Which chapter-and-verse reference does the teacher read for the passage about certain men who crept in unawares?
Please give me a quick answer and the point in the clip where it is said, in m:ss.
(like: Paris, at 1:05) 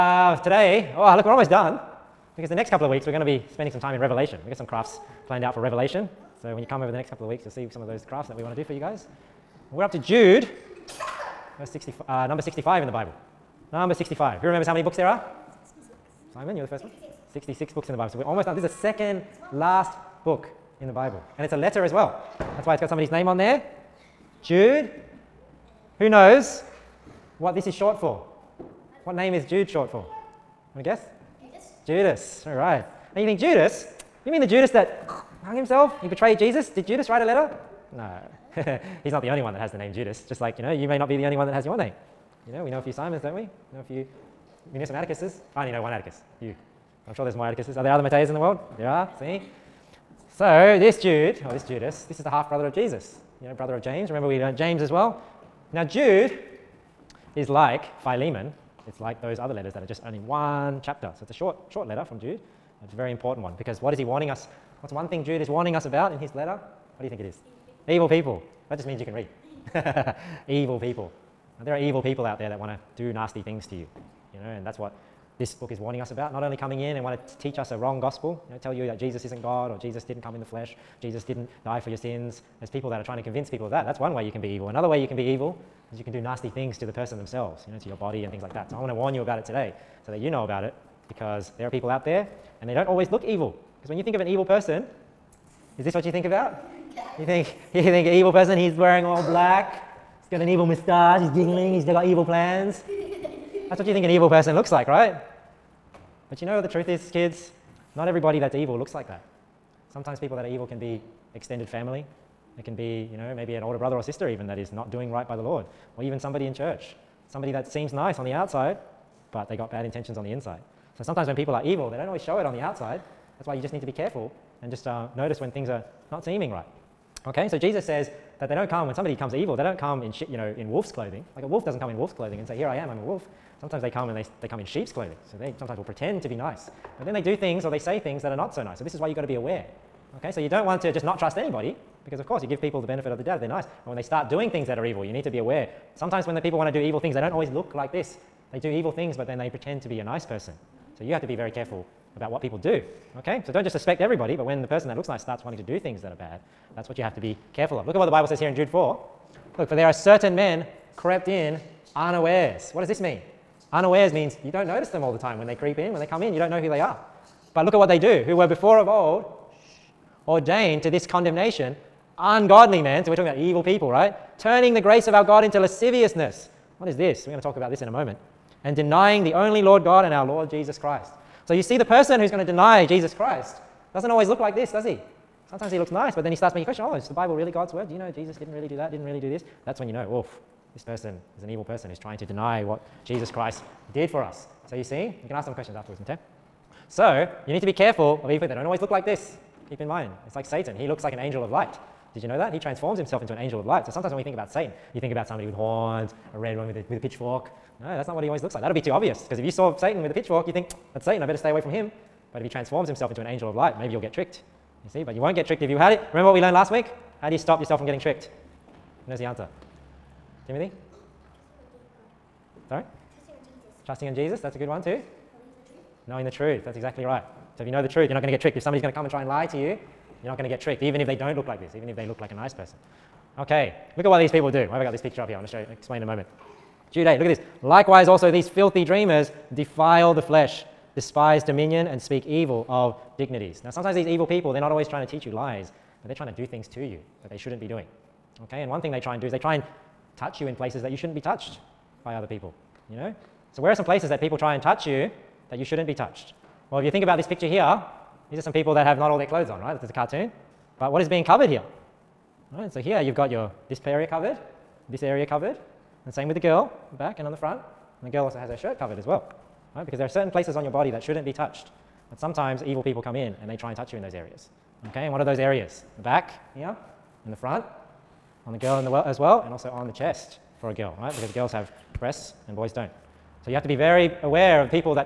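Jude 4, at 2:38.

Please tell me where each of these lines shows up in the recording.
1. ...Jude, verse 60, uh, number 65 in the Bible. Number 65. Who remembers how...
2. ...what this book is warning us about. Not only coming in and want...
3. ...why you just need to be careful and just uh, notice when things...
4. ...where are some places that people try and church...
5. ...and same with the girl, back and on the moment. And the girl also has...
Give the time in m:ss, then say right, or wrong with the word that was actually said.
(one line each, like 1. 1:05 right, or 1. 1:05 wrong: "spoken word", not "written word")
1. 0:09 right
2. 1:14 right
3. 2:03 right
4. 4:13 wrong: "touch", not "church"
5. 4:26 wrong: "front", not "moment".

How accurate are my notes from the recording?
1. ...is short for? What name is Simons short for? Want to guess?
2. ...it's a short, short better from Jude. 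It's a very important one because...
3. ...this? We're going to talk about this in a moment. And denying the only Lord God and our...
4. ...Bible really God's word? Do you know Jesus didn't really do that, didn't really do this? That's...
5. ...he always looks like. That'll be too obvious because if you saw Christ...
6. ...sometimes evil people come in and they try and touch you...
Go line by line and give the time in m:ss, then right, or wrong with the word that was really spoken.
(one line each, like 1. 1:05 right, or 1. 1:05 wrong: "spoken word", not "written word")
1. 0:27 wrong: "Jude", not "Simons"
2. 1:01 wrong: "letter", not "better"
3. 2:56 right
4. 3:07 right
5. 3:28 wrong: "Satan", not "Christ"
6. 4:32 right.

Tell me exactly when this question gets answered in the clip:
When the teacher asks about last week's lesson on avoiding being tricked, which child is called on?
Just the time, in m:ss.
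3:40.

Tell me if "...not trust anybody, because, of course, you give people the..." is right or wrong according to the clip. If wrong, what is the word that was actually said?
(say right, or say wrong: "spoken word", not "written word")
right.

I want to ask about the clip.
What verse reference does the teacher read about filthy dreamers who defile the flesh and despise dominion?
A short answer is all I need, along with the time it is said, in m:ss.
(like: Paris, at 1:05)
Jude 8, at 3:56.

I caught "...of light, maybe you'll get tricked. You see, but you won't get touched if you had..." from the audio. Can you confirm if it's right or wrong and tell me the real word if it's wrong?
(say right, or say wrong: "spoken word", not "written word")
wrong: "tricked", not "touched".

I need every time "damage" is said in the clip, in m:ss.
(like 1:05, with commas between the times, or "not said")
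not said.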